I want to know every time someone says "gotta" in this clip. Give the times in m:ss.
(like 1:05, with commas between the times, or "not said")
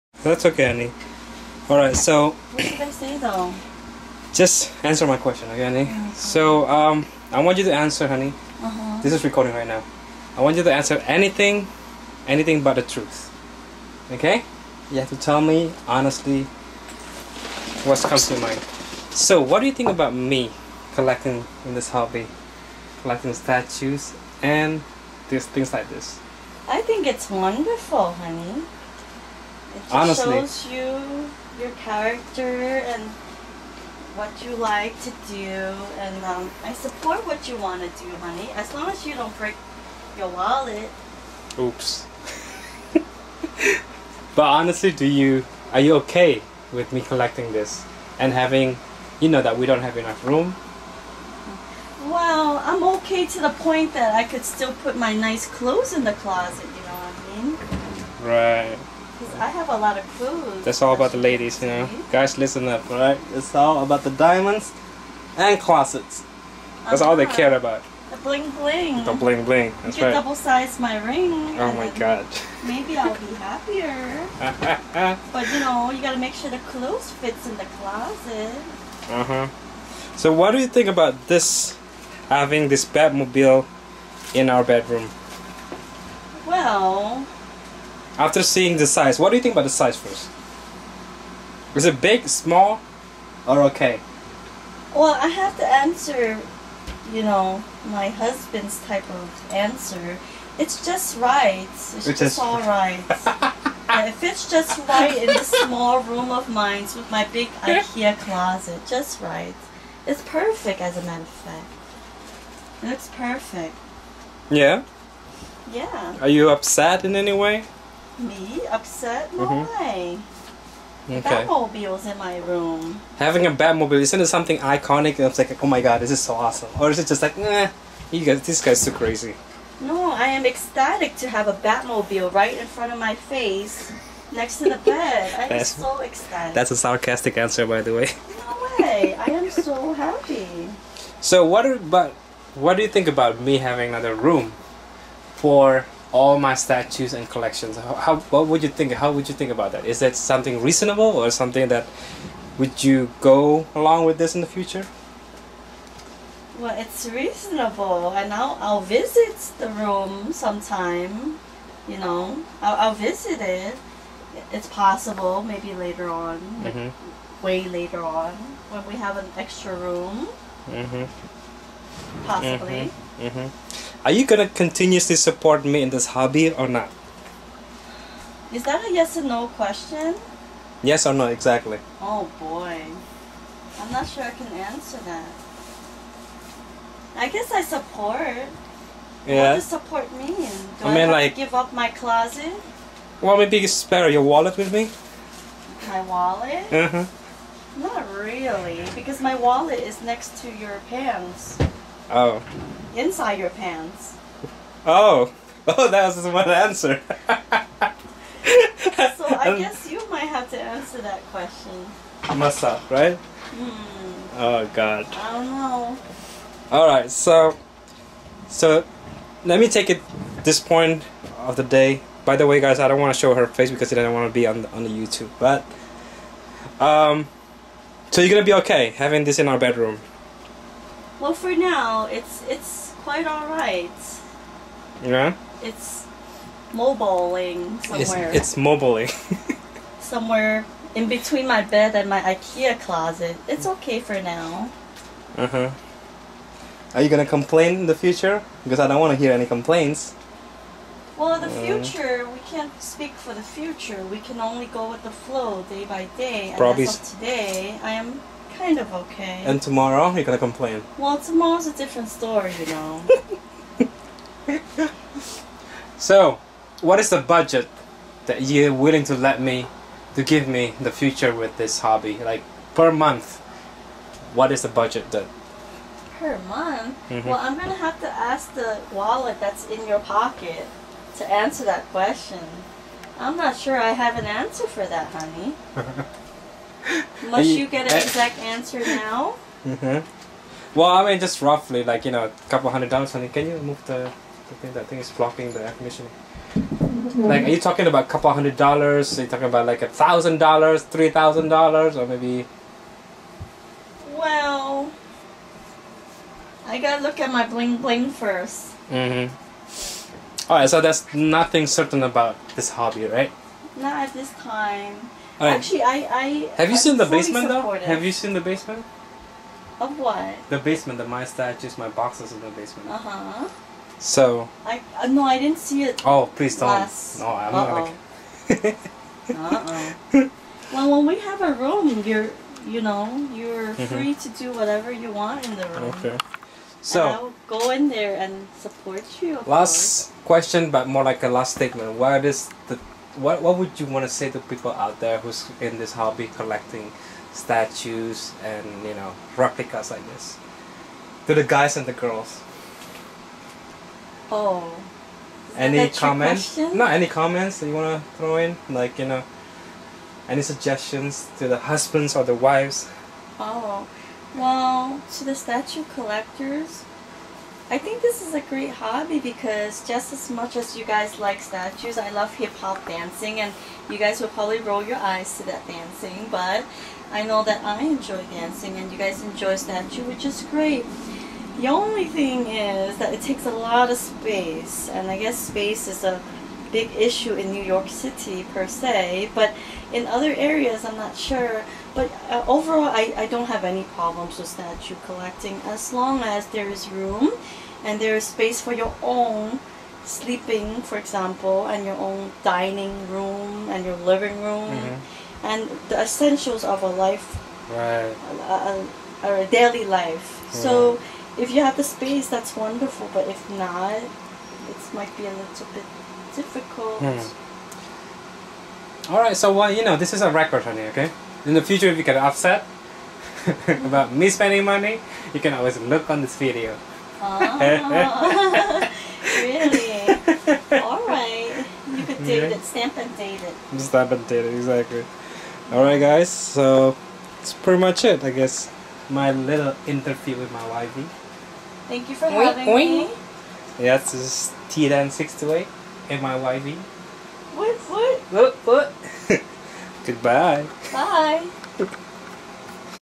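1:16, 5:06.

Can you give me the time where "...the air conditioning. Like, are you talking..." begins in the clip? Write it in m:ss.
4:55.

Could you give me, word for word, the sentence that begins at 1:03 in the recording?
It's all about the diamonds and closets.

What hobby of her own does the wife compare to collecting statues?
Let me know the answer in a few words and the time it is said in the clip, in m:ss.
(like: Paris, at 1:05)
hip-hop dancing, at 6:12.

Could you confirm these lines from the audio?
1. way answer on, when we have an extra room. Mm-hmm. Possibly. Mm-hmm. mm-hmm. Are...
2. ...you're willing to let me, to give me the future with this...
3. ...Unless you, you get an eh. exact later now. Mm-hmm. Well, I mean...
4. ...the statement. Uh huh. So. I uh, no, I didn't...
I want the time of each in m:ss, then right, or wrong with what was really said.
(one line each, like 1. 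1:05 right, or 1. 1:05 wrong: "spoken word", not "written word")
1. 2:47 wrong: "later", not "answer"
2. 4:28 right
3. 4:47 wrong: "answer", not "later"
4. 5:22 wrong: "basement", not "statement".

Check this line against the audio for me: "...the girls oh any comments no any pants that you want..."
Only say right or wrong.
wrong.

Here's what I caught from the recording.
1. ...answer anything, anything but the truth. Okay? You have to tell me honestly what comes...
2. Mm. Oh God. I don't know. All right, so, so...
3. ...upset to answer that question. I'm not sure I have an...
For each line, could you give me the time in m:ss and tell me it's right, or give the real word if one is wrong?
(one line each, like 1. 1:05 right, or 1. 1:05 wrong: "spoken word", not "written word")
1. 0:10 right
2. 3:33 right
3. 4:40 wrong: "pocket", not "upset".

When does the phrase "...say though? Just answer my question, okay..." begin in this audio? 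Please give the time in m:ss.
0:02.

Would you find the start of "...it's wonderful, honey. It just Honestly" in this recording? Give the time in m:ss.
0:27.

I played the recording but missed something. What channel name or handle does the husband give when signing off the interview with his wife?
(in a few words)
TDAN 628.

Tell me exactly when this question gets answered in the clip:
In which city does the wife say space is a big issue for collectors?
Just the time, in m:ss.
6:27.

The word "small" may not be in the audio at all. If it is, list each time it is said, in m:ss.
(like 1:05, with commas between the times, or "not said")
1:32, 1:45.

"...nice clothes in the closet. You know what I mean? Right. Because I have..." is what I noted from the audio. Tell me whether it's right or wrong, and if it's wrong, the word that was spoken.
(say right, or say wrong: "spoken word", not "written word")
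right.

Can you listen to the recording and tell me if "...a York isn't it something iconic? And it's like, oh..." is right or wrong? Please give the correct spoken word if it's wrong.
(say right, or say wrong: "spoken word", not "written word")
wrong: "Batmobile", not "York".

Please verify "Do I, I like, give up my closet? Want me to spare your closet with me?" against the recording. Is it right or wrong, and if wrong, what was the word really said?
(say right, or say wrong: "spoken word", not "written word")
wrong: "wallet", not "closet".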